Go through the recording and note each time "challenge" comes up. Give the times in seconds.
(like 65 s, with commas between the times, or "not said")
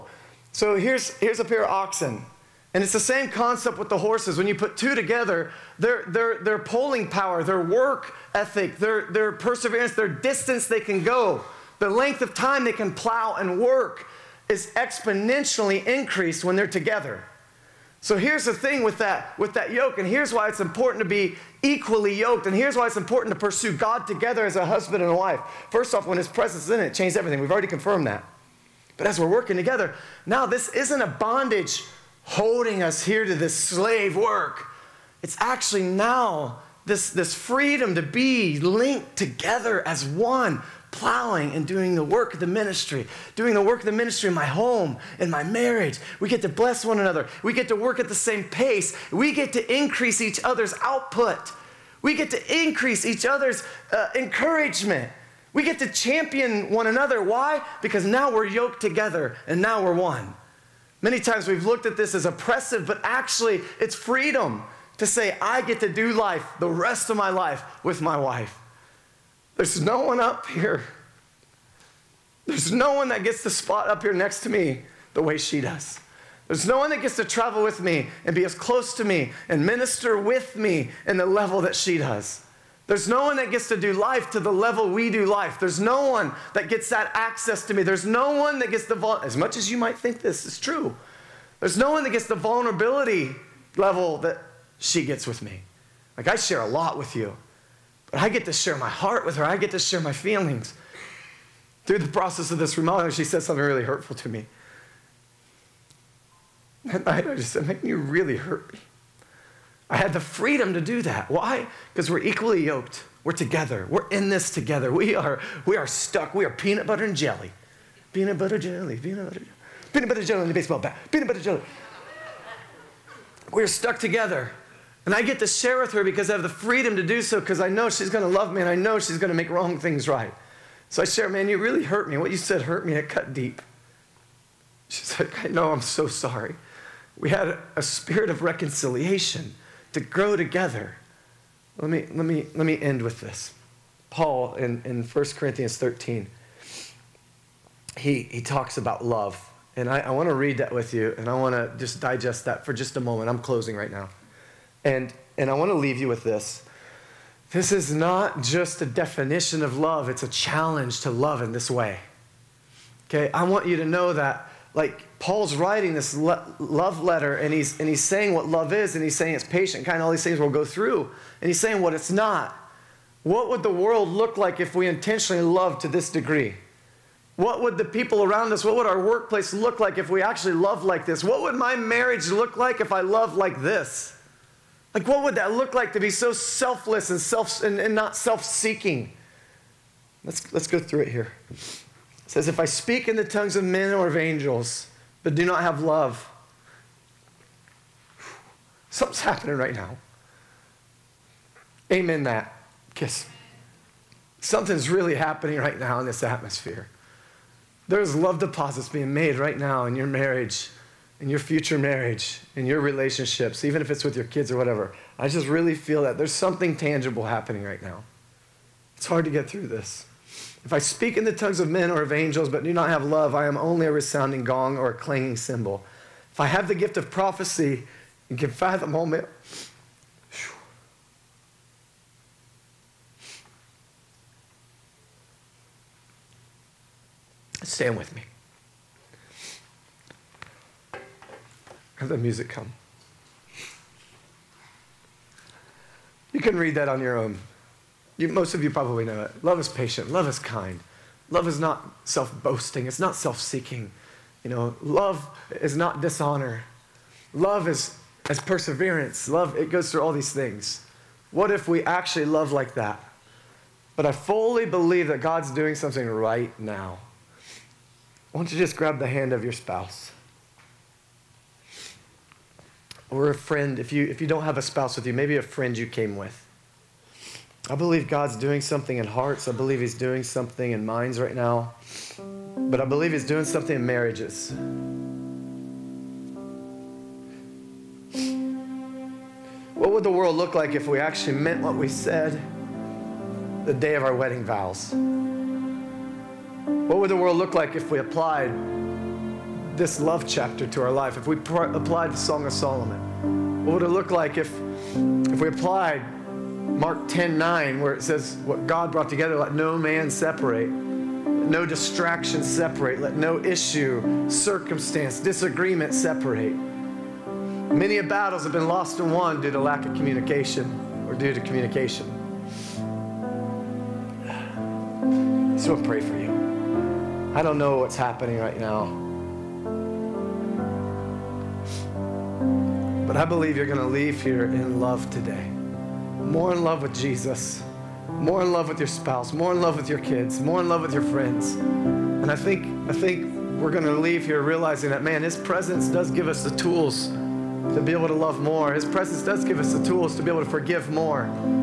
160 s.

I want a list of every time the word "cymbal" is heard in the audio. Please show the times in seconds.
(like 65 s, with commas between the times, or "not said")
225 s.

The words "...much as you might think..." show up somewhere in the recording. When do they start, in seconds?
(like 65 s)
89 s.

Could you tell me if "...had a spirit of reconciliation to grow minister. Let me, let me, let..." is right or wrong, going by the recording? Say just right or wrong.
wrong.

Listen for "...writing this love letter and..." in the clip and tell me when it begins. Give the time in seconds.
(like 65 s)
165 s.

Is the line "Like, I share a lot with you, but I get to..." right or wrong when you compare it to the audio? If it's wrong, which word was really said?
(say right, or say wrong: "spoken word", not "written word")
right.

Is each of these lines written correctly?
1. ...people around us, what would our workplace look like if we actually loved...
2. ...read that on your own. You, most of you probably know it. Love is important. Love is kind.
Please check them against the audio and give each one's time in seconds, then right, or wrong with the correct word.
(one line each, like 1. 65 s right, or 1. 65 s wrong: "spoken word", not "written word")
1. 177 s right
2. 246 s wrong: "patient", not "important".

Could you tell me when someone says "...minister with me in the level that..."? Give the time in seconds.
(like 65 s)
79 s.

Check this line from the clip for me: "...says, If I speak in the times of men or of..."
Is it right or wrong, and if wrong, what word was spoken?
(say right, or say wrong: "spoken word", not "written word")
wrong: "tongues", not "times".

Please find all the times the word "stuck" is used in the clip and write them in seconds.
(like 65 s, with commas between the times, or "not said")
115 s, 123 s.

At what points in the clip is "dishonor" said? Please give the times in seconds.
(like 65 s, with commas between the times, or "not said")
256 s.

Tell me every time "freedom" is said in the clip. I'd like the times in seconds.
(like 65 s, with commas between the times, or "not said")
37 s, 63 s, 110 s, 126 s.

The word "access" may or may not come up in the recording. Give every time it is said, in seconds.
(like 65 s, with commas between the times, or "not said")
87 s.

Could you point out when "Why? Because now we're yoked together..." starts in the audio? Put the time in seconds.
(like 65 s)
57 s.